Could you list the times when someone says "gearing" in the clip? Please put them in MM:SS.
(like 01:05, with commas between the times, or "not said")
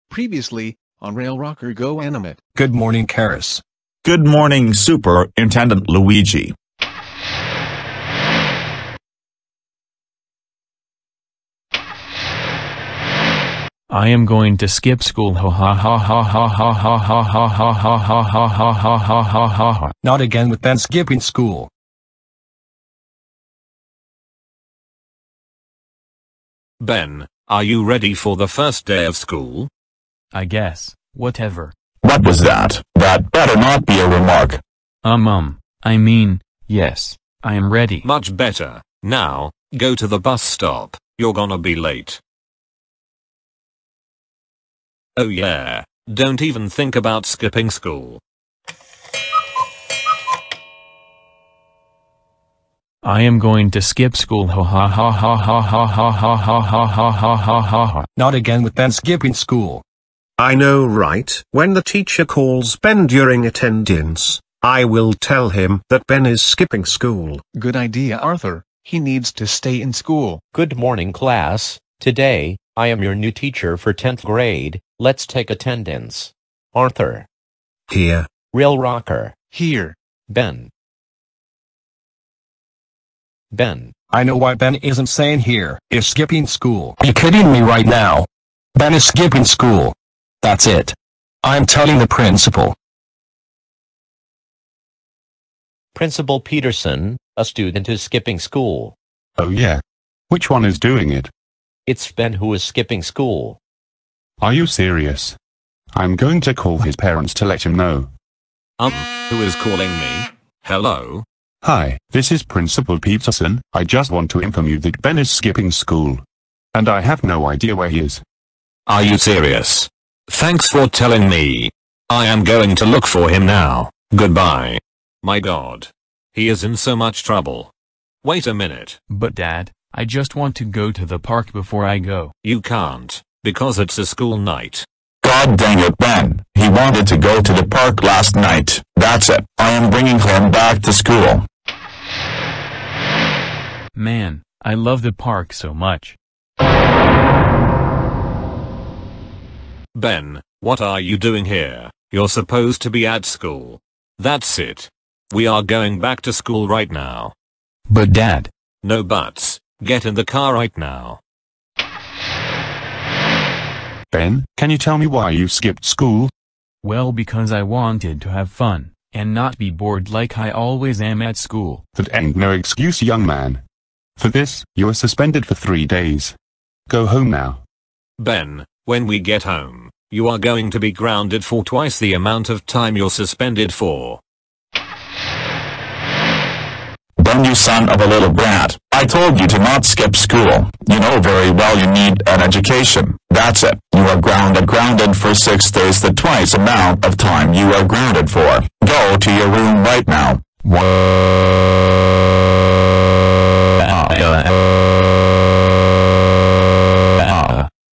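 not said.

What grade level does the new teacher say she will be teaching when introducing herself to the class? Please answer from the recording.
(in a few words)
10th grade.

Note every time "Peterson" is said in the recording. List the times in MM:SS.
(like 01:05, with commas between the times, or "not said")
01:36, 01:52.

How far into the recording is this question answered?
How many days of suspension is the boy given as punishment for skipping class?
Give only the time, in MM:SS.
02:55.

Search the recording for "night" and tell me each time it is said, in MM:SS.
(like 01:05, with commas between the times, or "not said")
02:14, 02:18.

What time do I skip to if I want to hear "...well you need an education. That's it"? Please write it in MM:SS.
03:11.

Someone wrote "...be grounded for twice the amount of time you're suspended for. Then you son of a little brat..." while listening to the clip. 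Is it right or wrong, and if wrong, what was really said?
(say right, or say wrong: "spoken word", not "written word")
right.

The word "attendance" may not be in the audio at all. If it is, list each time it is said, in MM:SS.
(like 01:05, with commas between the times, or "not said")
01:03, 01:15.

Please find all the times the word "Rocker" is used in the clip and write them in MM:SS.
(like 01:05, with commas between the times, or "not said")
00:01, 01:18.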